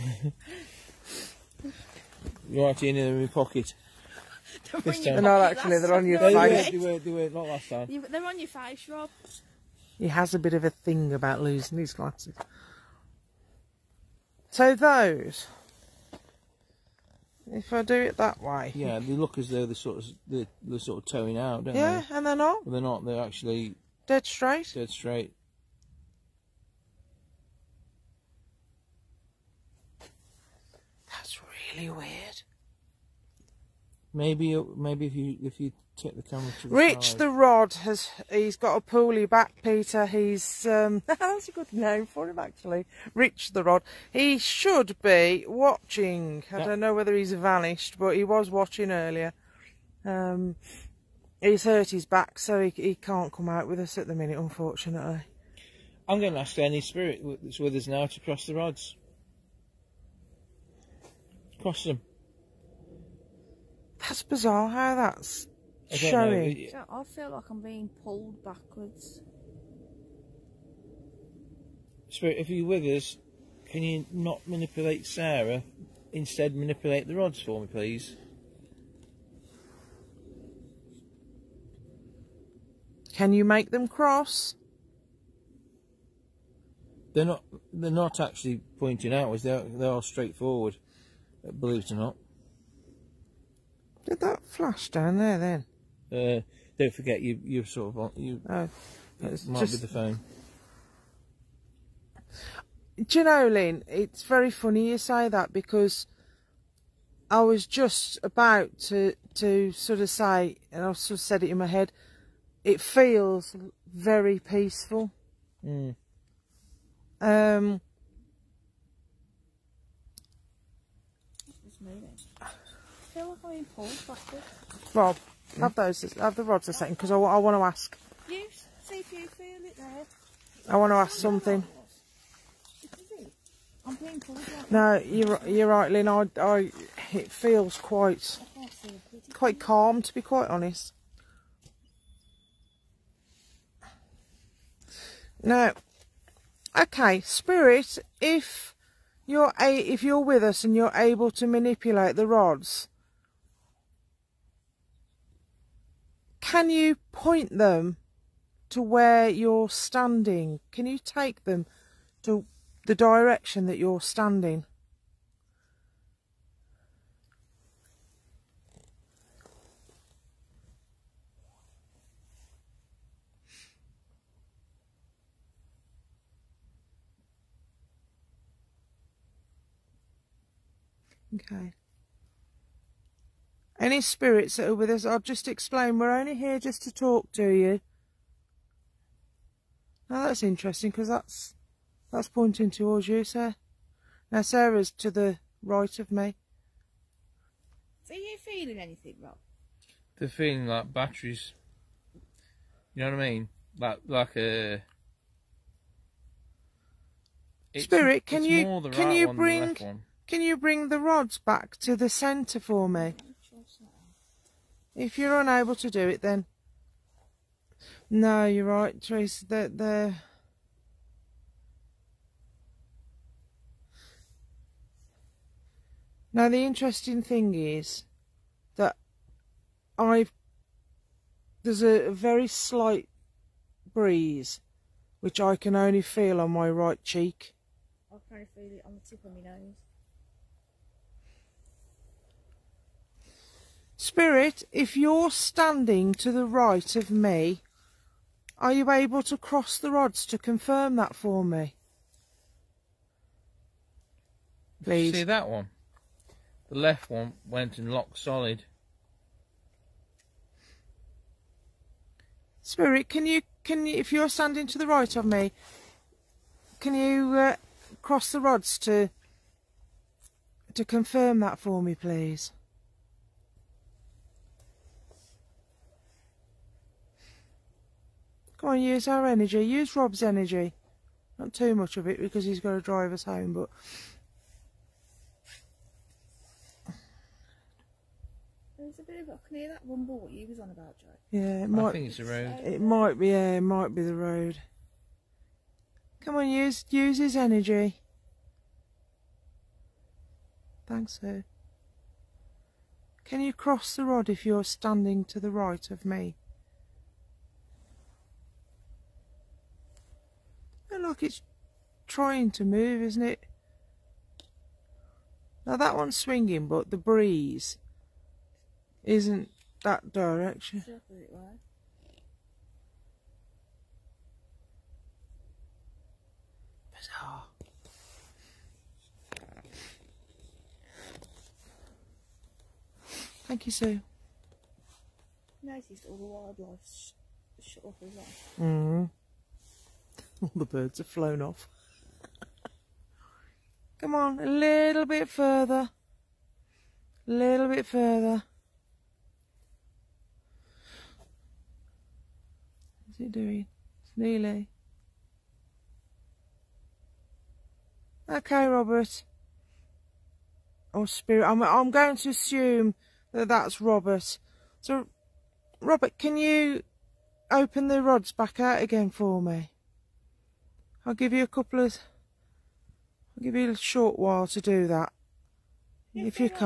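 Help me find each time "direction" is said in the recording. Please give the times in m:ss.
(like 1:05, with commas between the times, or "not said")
2:42, 5:20.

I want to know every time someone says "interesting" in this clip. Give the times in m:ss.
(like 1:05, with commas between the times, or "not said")
3:10, 3:46.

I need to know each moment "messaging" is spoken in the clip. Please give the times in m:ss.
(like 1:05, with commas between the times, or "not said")
not said.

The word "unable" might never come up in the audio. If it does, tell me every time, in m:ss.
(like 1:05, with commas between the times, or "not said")
3:35.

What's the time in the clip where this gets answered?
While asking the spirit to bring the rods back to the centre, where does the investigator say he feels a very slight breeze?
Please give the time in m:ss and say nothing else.
3:56.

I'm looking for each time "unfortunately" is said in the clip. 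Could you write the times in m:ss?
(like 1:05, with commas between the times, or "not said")
0:54.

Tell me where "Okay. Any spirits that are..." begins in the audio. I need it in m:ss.
3:01.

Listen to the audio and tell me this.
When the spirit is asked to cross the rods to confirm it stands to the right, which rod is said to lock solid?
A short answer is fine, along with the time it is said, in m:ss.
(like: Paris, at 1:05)
The left one, at 4:16.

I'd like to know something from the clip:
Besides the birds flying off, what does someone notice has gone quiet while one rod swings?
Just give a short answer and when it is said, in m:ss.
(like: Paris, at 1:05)
The wildlife, at 5:36.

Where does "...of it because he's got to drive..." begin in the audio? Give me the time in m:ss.
4:41.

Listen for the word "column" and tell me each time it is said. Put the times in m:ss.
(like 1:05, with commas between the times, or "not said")
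not said.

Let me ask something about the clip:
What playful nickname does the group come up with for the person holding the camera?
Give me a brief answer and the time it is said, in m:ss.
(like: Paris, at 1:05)
Rich the Rod, at 0:43.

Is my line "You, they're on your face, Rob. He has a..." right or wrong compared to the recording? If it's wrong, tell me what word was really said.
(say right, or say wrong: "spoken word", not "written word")
right.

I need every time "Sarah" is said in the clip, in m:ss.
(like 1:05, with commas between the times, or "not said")
1:15, 3:14.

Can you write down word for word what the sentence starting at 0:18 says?
Yeah, they look as though they're sort of they're, they're sort of towing out, don't yeah, they?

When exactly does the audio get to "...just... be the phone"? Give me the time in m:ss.
1:39.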